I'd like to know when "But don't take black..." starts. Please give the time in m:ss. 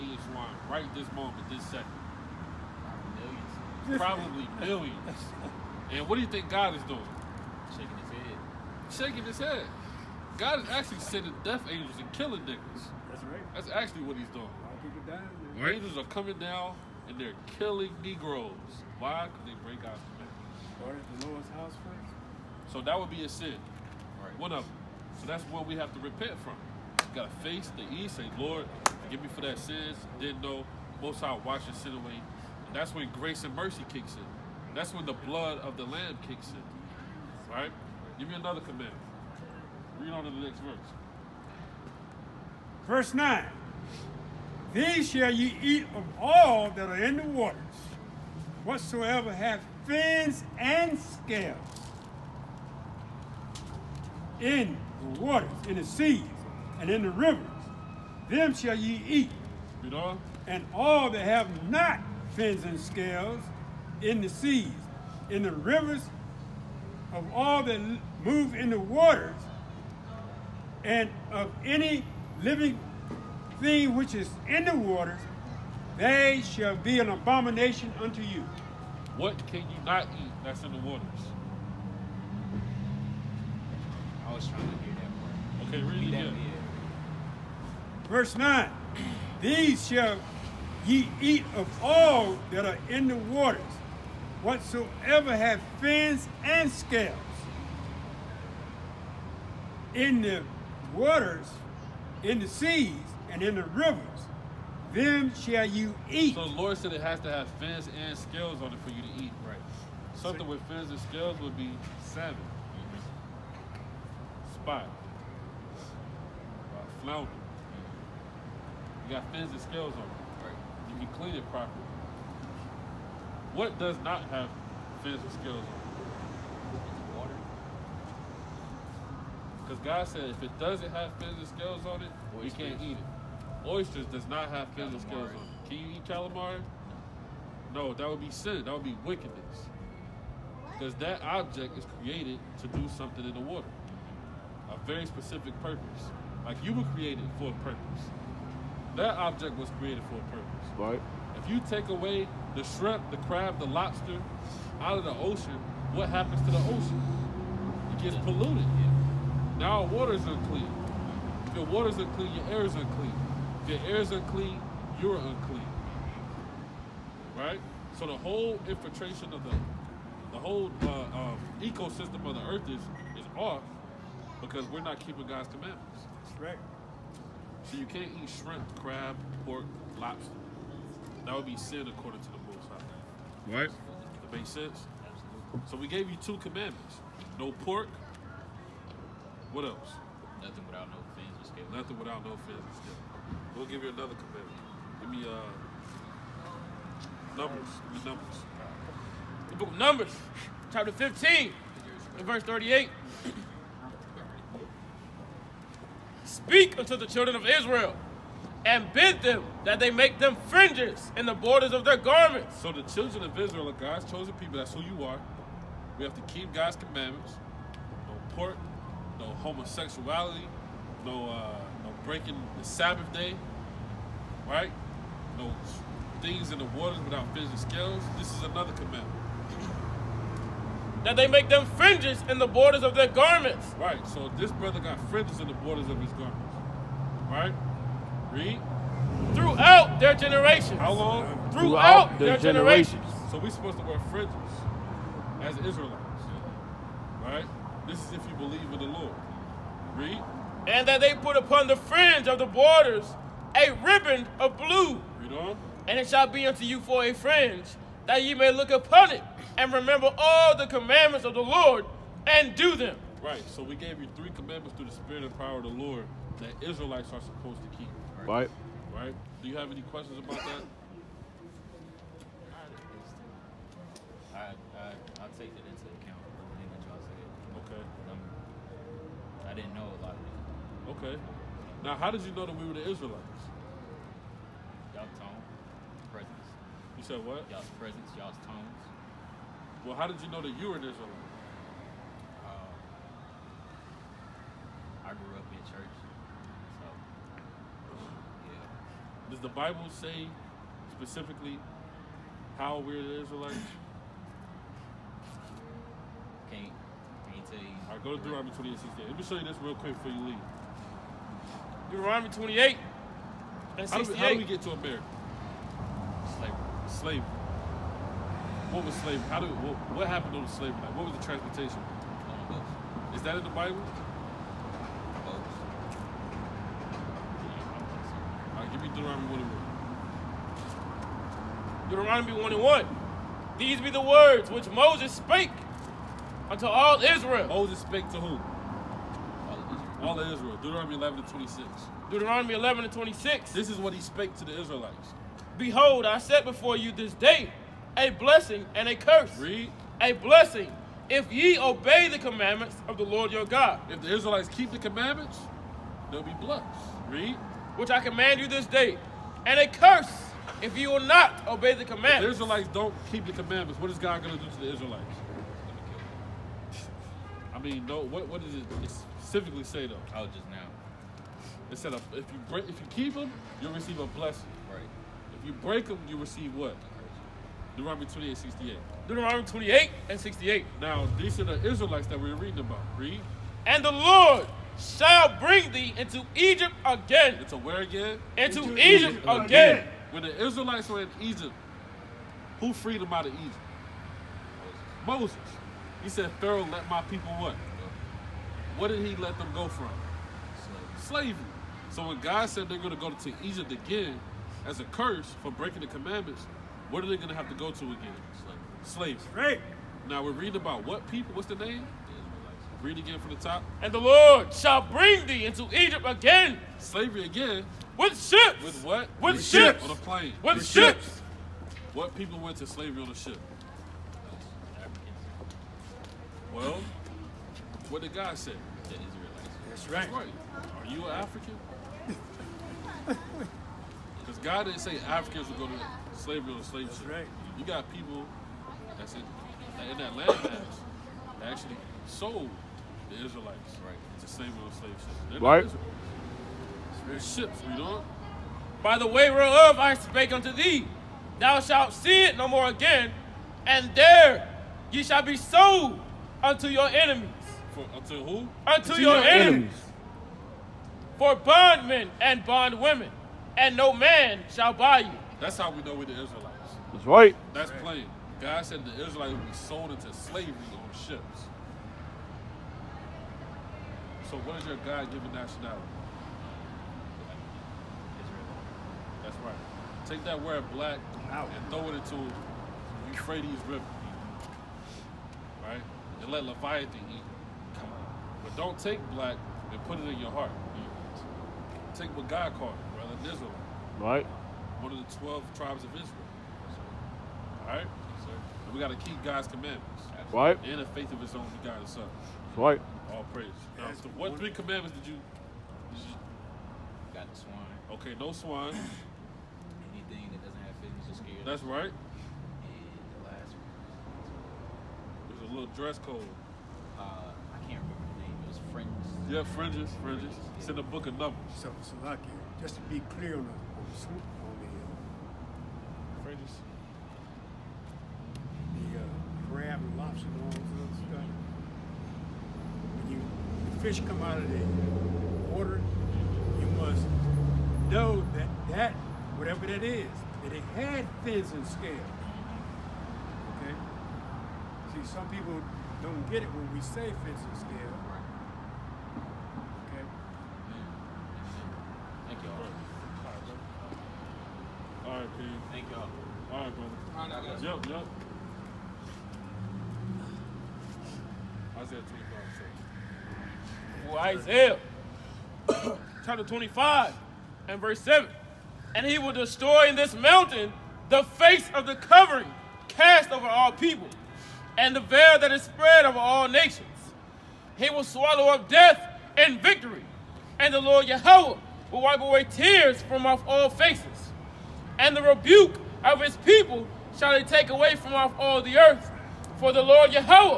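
8:08.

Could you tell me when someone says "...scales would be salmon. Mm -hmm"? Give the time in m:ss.
1:50.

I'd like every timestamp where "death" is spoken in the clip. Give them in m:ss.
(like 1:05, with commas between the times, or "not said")
0:11, 9:38.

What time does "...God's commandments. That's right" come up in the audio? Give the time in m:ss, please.
2:55.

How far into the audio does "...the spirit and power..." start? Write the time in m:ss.
4:24.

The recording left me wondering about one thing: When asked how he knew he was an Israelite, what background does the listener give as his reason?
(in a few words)
Grew up in church.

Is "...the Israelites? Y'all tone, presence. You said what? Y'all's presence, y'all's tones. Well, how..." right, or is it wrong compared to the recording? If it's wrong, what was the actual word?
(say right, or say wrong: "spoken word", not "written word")
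right.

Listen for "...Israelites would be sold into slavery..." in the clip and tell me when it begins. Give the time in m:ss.
7:49.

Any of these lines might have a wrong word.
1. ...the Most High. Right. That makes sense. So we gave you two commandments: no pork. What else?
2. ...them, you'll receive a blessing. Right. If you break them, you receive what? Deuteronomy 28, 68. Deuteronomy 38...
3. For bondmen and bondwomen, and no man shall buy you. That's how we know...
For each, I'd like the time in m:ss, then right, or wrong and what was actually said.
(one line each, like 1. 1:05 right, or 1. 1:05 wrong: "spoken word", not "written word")
1. 3:02 right
2. 6:13 wrong: "28", not "38"
3. 7:41 right.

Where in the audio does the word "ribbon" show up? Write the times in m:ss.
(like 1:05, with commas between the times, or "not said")
4:13.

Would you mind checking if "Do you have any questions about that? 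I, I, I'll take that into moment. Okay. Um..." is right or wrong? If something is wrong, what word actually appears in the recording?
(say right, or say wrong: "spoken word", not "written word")
wrong: "account", not "moment".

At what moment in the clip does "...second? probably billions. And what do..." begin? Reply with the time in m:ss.
0:01.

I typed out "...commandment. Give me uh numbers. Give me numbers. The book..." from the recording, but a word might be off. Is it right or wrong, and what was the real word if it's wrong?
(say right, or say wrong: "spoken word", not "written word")
right.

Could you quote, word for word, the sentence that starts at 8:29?
Anything that doesn't have fins is scared.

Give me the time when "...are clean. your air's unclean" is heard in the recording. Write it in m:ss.
2:41.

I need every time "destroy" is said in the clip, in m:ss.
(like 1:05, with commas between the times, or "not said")
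9:29.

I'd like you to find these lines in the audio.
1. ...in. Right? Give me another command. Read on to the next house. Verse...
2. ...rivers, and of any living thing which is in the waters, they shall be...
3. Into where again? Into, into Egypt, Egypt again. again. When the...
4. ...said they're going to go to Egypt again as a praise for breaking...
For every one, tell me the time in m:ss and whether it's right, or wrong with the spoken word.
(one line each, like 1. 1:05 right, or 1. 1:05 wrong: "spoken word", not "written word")
1. 0:36 wrong: "verse", not "house"
2. 1:08 wrong: "waters", not "rivers"
3. 6:27 right
4. 6:42 wrong: "curse", not "praise".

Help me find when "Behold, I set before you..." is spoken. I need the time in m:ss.
5:45.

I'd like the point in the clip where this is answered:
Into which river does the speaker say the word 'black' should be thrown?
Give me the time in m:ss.
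8:03.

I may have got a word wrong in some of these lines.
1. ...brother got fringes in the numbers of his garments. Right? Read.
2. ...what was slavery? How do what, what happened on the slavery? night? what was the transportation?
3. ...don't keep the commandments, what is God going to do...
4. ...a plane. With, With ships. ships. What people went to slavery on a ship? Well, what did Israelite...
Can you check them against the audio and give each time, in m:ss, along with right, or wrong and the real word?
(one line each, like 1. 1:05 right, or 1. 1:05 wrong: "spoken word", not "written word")
1. 3:54 wrong: "borders", not "numbers"
2. 5:18 right
3. 6:02 right
4. 6:59 wrong: "God", not "Israelite".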